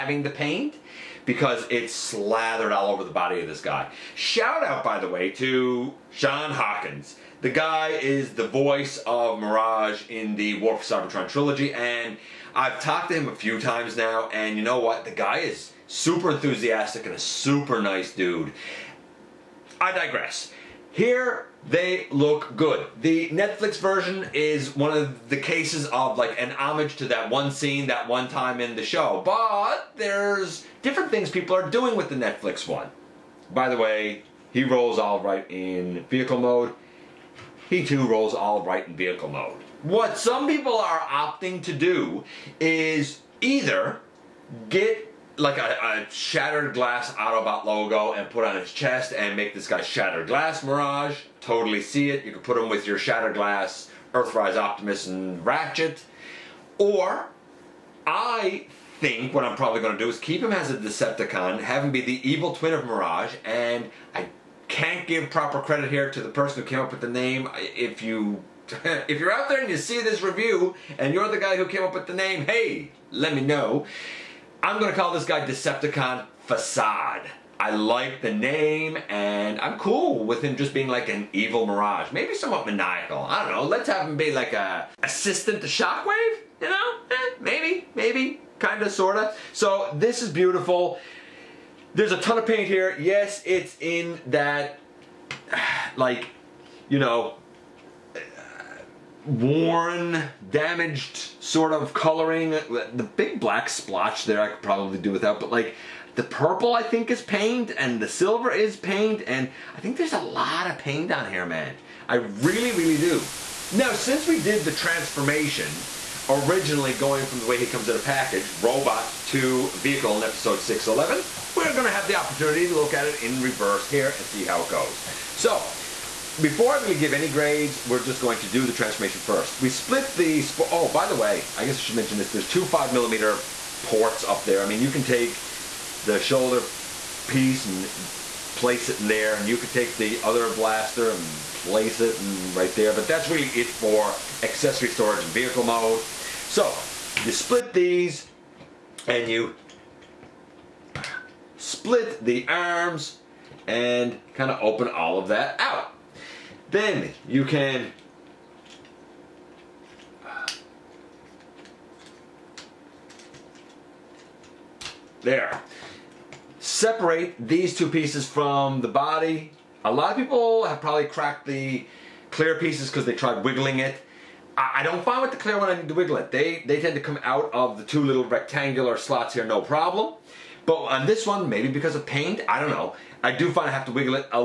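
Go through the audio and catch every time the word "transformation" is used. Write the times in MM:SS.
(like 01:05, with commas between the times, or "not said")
01:54, 02:08.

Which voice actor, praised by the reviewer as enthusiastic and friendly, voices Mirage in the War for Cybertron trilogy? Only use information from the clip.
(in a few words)
Sean Hawkins.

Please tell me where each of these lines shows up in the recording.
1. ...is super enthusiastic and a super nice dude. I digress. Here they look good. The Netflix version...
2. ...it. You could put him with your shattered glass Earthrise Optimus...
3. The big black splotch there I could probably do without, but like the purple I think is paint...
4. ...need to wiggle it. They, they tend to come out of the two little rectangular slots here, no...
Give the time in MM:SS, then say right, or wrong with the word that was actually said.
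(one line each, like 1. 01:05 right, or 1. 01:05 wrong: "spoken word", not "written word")
1. 00:15 right
2. 00:52 right
3. 01:42 right
4. 02:55 right.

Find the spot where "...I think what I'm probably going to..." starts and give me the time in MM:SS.
00:58.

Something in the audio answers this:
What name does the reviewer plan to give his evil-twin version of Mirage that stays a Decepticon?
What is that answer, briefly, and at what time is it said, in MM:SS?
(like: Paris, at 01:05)
Decepticon Facade, at 01:15.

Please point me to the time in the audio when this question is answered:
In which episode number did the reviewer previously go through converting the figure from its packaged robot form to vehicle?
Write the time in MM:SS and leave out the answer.
02:00.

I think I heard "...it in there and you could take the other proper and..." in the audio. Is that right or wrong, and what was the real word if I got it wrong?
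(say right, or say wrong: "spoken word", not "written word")
wrong: "blaster", not "proper".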